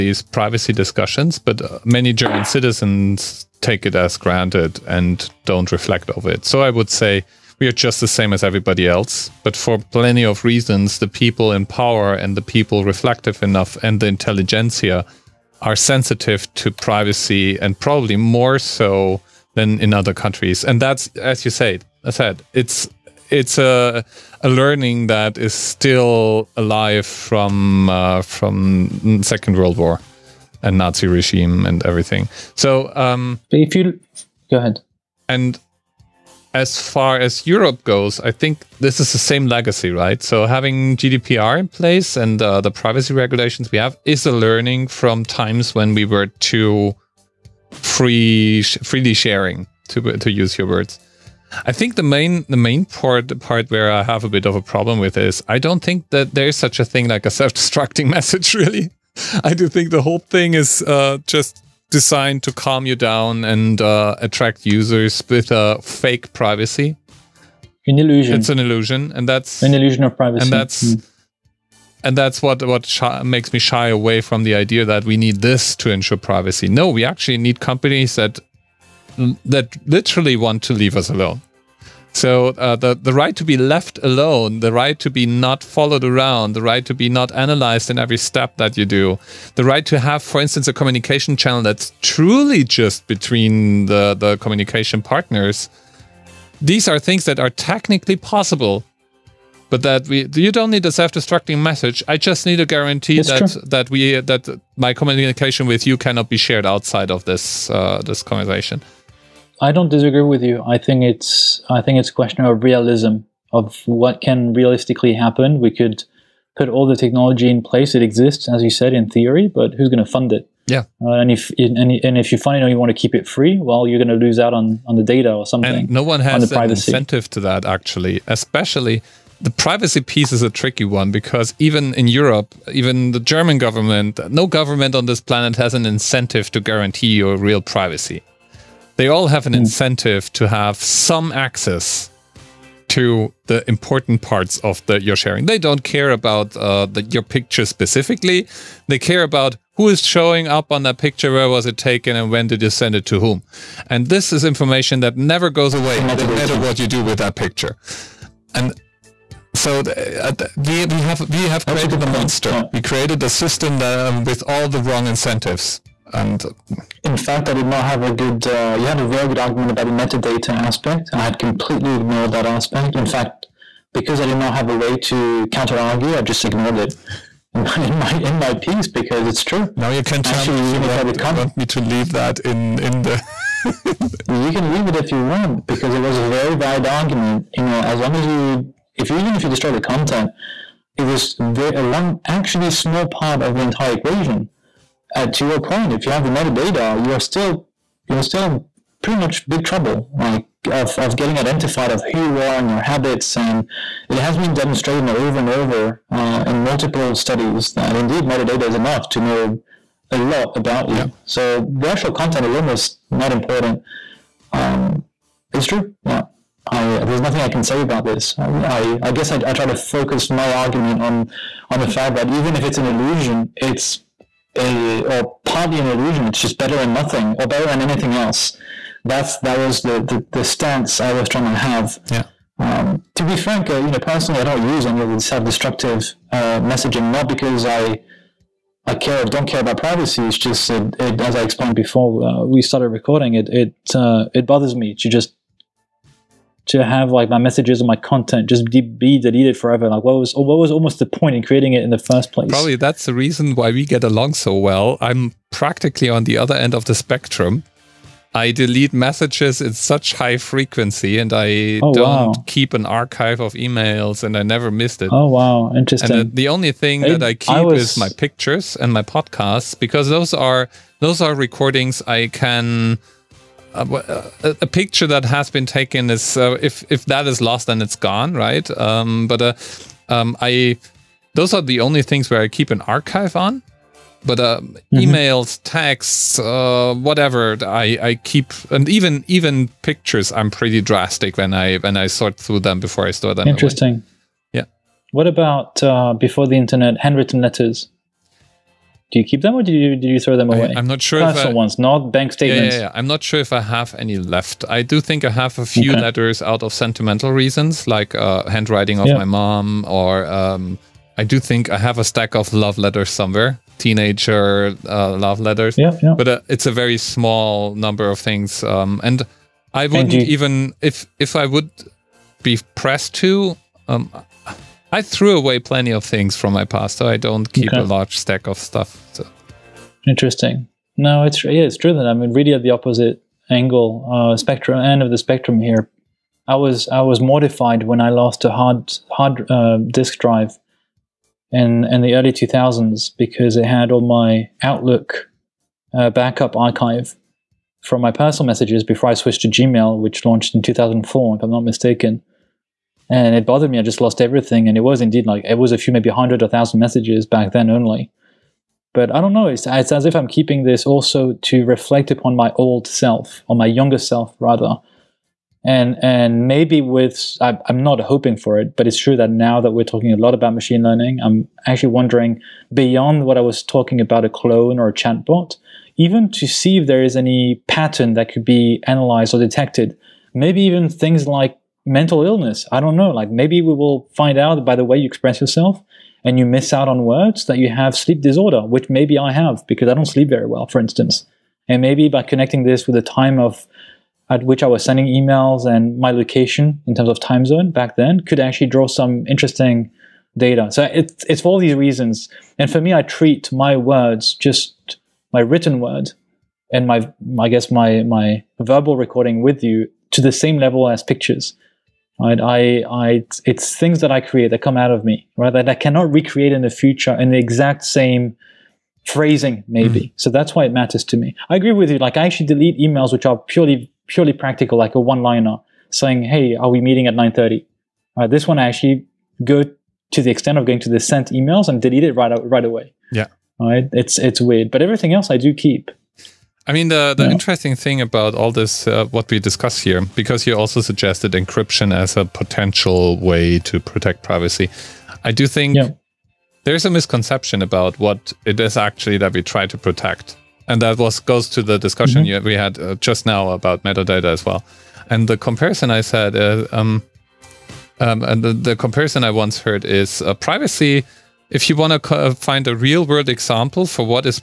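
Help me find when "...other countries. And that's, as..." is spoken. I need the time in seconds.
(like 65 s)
19 s.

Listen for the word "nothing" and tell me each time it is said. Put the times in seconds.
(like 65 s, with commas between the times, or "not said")
217 s, 226 s.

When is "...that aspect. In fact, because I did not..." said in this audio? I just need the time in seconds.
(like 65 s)
172 s.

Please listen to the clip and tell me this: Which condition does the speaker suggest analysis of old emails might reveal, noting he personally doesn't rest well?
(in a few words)
sleep disorder.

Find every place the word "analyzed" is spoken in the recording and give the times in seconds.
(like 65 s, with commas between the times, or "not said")
87 s, 378 s.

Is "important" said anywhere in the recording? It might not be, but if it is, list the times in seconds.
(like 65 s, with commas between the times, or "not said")
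143 s, 213 s.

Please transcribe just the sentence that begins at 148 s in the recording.
They care about who is showing up on that picture, where was it taken, and when did you send it to whom.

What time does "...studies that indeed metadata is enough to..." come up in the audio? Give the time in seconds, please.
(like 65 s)
207 s.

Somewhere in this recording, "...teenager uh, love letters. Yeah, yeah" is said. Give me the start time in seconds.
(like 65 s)
313 s.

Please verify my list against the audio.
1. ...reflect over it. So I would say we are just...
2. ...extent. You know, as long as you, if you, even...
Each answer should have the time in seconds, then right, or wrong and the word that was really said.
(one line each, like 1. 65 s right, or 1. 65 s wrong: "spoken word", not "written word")
1. 5 s right
2. 186 s wrong: "argument", not "extent".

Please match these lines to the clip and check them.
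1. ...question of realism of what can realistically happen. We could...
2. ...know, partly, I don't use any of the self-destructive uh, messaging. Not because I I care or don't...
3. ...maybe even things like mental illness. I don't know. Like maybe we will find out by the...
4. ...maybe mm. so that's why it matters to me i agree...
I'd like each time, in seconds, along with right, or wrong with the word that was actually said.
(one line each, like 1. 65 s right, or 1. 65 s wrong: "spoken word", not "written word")
1. 112 s right
2. 233 s wrong: "personally", not "partly"
3. 380 s right
4. 419 s right.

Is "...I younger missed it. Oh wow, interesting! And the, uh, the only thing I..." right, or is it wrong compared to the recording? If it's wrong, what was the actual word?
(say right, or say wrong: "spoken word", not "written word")
wrong: "never", not "younger".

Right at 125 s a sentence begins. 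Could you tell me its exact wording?
And no one has on an incentive to that actually, especially.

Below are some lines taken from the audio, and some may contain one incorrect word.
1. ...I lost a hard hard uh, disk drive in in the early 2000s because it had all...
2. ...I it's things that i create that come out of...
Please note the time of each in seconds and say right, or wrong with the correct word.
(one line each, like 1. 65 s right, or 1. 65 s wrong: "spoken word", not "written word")
1. 338 s right
2. 412 s right.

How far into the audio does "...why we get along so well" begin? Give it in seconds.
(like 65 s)
253 s.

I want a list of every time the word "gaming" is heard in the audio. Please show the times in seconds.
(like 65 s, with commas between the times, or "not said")
not said.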